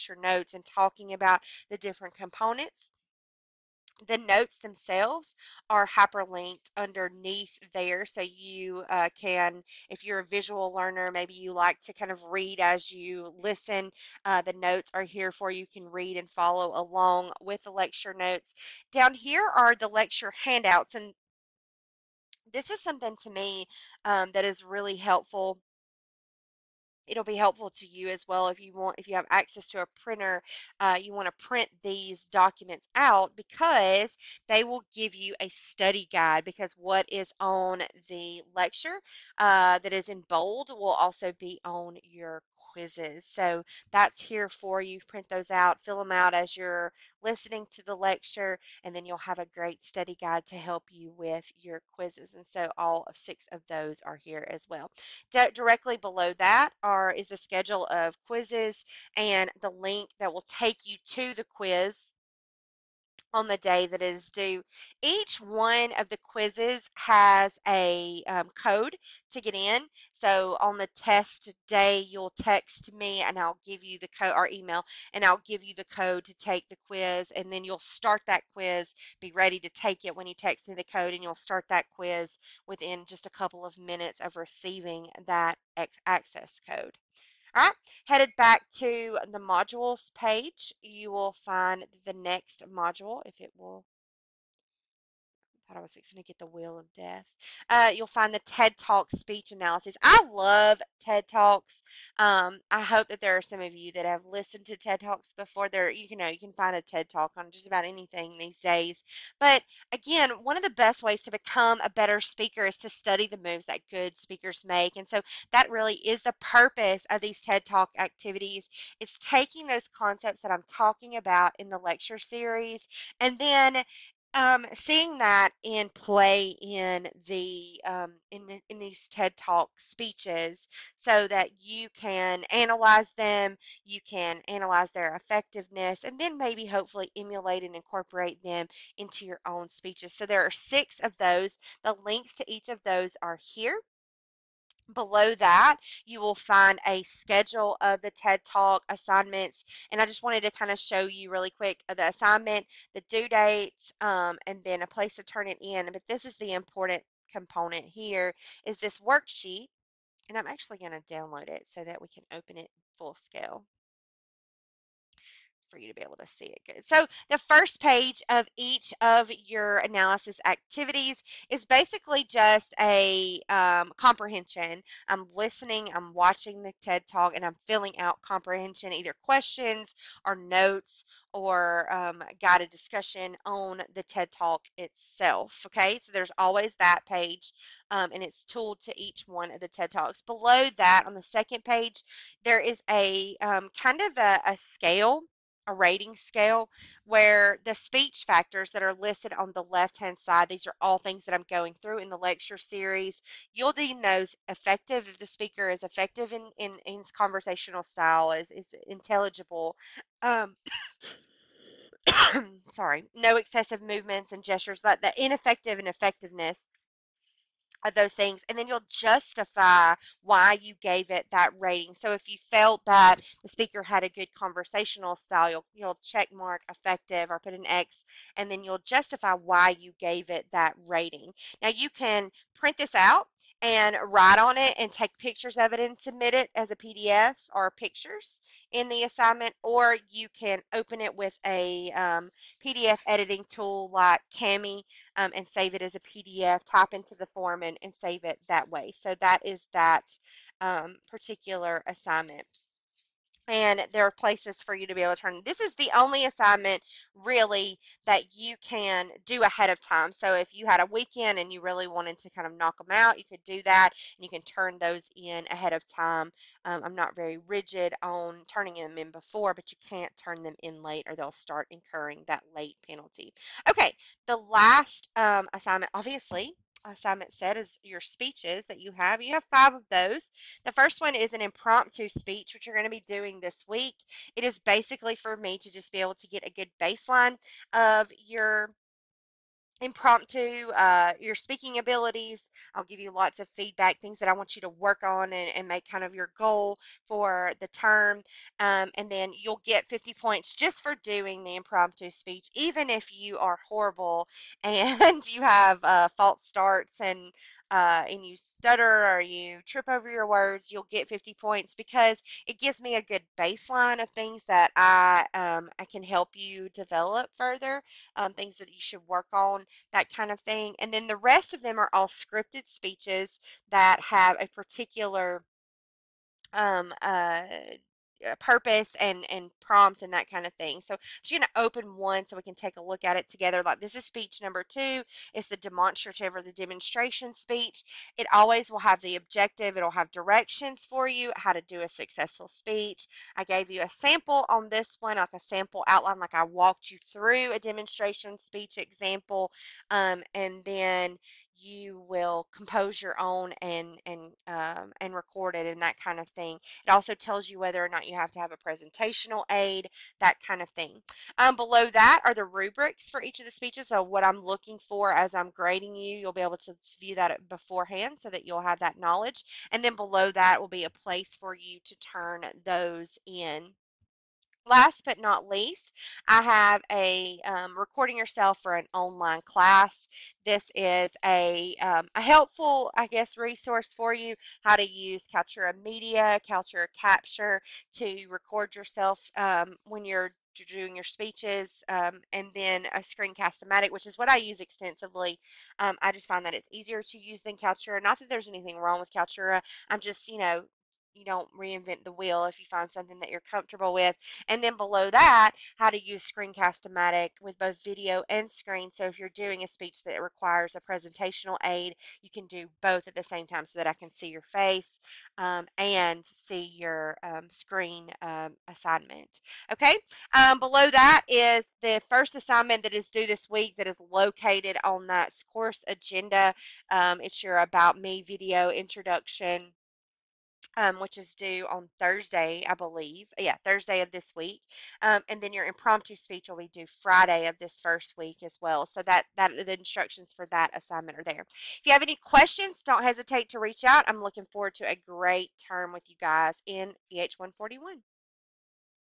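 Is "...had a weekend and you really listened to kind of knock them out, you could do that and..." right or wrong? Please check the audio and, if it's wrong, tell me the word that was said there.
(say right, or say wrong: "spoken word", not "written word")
wrong: "wanted", not "listened".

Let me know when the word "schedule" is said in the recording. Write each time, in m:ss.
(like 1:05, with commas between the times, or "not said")
0:57, 2:27.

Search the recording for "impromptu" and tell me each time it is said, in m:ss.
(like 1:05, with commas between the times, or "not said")
4:41, 4:49, 5:01, 7:15.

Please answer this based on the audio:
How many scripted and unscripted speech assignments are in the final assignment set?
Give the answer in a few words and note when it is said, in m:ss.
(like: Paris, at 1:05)
5, at 4:39.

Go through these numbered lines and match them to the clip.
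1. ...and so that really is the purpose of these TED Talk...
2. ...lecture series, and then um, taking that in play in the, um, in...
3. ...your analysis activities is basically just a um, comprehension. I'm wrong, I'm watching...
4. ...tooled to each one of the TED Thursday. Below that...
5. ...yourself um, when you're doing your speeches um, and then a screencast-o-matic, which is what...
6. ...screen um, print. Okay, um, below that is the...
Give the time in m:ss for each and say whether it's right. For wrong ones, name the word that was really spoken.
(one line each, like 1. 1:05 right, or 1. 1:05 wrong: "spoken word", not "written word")
1. 1:54 right
2. 2:01 wrong: "seeing", not "taking"
3. 2:49 wrong: "listening", not "wrong"
4. 3:08 wrong: "Talks", not "Thursday"
5. 6:28 right
6. 6:57 wrong: "assignment", not "print".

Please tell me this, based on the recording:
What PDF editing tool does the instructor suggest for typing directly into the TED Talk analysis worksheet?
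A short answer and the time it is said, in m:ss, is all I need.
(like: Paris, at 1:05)
Kami, at 4:04.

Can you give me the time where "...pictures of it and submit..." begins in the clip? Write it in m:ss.
3:55.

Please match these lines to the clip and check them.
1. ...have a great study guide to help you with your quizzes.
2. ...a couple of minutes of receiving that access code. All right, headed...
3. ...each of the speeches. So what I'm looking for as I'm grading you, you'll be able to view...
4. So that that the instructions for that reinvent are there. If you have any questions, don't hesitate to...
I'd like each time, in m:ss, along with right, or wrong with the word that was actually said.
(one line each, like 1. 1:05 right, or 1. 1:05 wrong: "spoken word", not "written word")
1. 0:49 right
2. 1:23 right
3. 6:03 right
4. 7:18 wrong: "assignment", not "reinvent".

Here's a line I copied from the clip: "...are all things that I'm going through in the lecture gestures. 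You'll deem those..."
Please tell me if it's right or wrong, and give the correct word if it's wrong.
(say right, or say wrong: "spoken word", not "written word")
wrong: "series", not "gestures".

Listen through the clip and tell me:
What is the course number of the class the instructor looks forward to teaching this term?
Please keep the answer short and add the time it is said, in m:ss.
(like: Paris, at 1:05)
EH141, at 7:27.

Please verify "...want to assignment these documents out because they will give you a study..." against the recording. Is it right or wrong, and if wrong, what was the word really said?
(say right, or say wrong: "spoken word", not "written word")
wrong: "print", not "assignment".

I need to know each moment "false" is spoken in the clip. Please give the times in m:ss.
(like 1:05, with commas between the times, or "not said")
5:06.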